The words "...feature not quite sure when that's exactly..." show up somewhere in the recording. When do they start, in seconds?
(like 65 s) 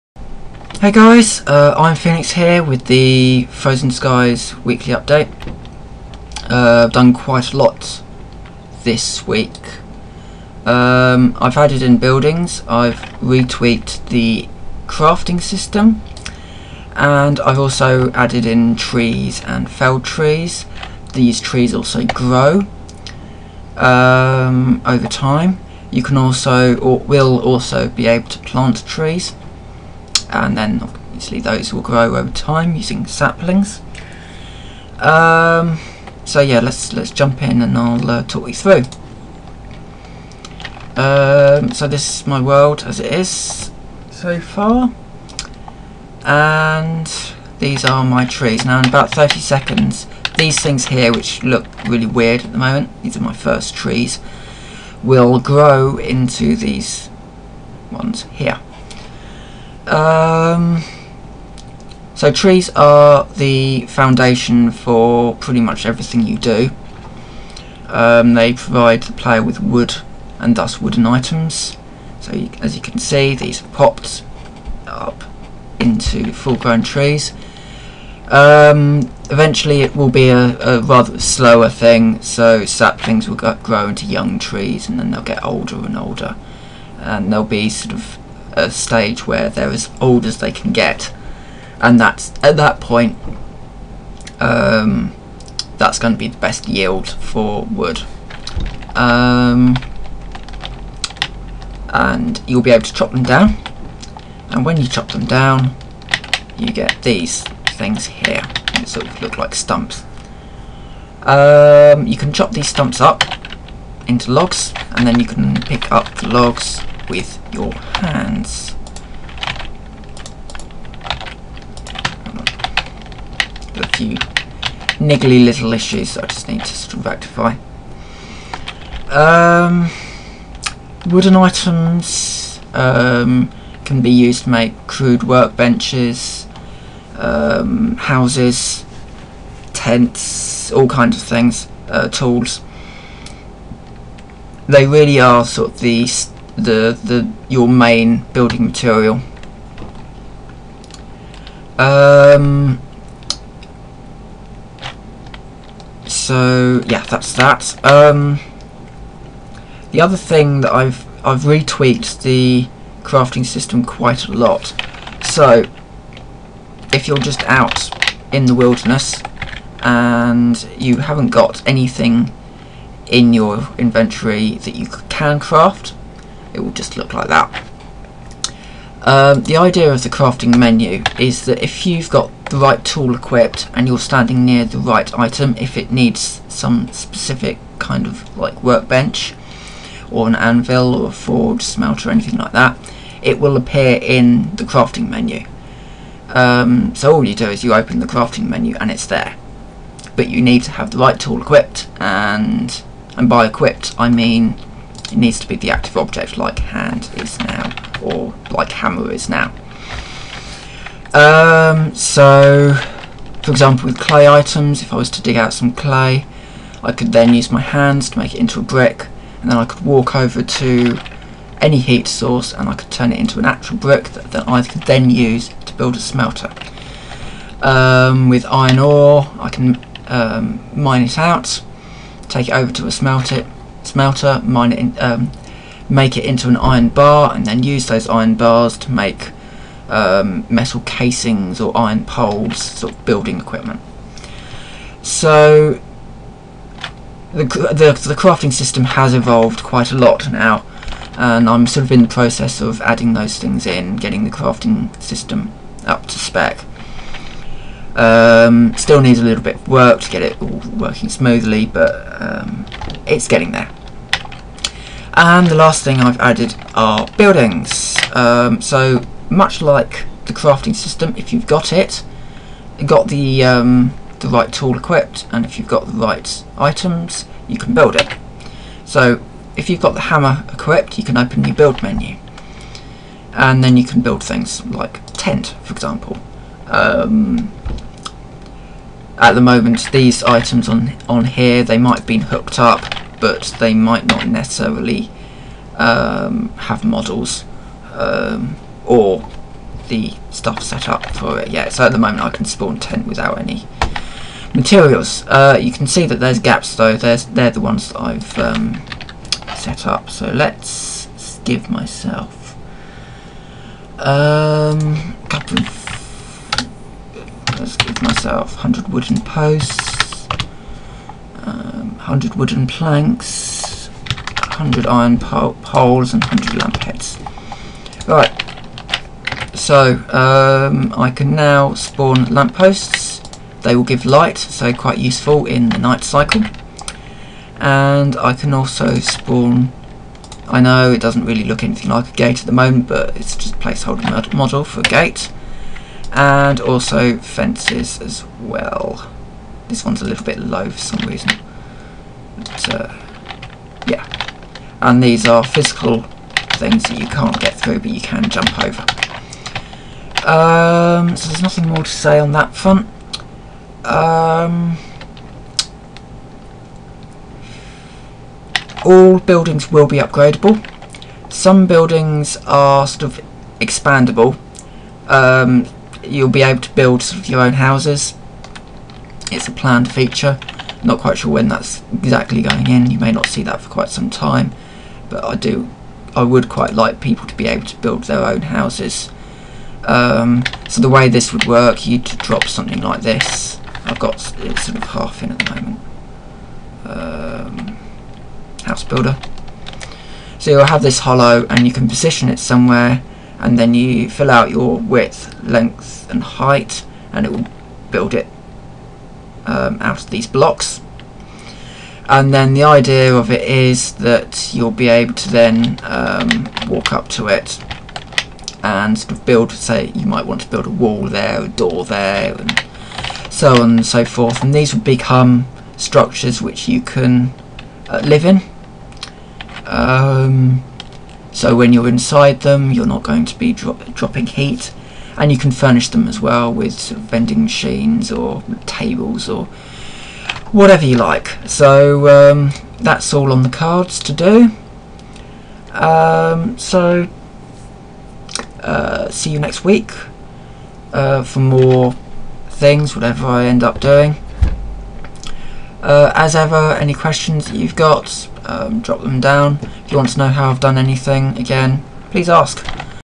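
379 s.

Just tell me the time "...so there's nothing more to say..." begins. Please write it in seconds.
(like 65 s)
361 s.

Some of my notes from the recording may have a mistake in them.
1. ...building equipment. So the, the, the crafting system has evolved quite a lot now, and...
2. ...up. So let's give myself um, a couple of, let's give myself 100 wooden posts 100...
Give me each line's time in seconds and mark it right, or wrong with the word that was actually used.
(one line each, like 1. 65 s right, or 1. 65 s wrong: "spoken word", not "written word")
1. 243 s right
2. 309 s right.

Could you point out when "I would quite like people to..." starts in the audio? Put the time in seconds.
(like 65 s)
386 s.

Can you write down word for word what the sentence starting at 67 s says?
Um, they provide the player with wood and thus wooden items.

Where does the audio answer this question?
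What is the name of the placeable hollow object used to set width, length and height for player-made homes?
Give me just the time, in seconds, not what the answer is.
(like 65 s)
398 s.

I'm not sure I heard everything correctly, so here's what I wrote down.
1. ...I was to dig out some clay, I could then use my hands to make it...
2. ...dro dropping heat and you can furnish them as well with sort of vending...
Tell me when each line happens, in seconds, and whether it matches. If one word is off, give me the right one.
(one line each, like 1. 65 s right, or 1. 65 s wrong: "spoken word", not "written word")
1. 214 s right
2. 433 s right.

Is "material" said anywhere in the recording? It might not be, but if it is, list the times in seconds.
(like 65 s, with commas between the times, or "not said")
148 s, 304 s.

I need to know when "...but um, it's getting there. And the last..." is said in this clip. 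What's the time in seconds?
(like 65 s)
261 s.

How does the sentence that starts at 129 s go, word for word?
Um, wooden items um, can be used to make crude workbenches, um, houses, tents, all kinds of things, uh, tools.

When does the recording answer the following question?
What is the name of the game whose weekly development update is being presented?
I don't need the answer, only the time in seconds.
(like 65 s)
3 s.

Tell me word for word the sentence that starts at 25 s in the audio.
You can also, or will also, be able to plant trees and then obviously those will grow over time using saplings.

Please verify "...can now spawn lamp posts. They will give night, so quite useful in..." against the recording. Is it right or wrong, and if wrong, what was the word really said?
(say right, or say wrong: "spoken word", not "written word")
wrong: "light", not "night".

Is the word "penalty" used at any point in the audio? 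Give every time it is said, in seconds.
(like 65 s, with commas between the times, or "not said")
not said.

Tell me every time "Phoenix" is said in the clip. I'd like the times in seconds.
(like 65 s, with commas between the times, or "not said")
1 s.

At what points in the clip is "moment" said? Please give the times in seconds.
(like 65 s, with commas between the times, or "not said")
52 s, 289 s, 301 s, 342 s, 395 s.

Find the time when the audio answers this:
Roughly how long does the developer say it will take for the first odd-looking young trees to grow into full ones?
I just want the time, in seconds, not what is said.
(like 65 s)
49 s.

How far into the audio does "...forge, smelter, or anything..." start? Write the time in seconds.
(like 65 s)
191 s.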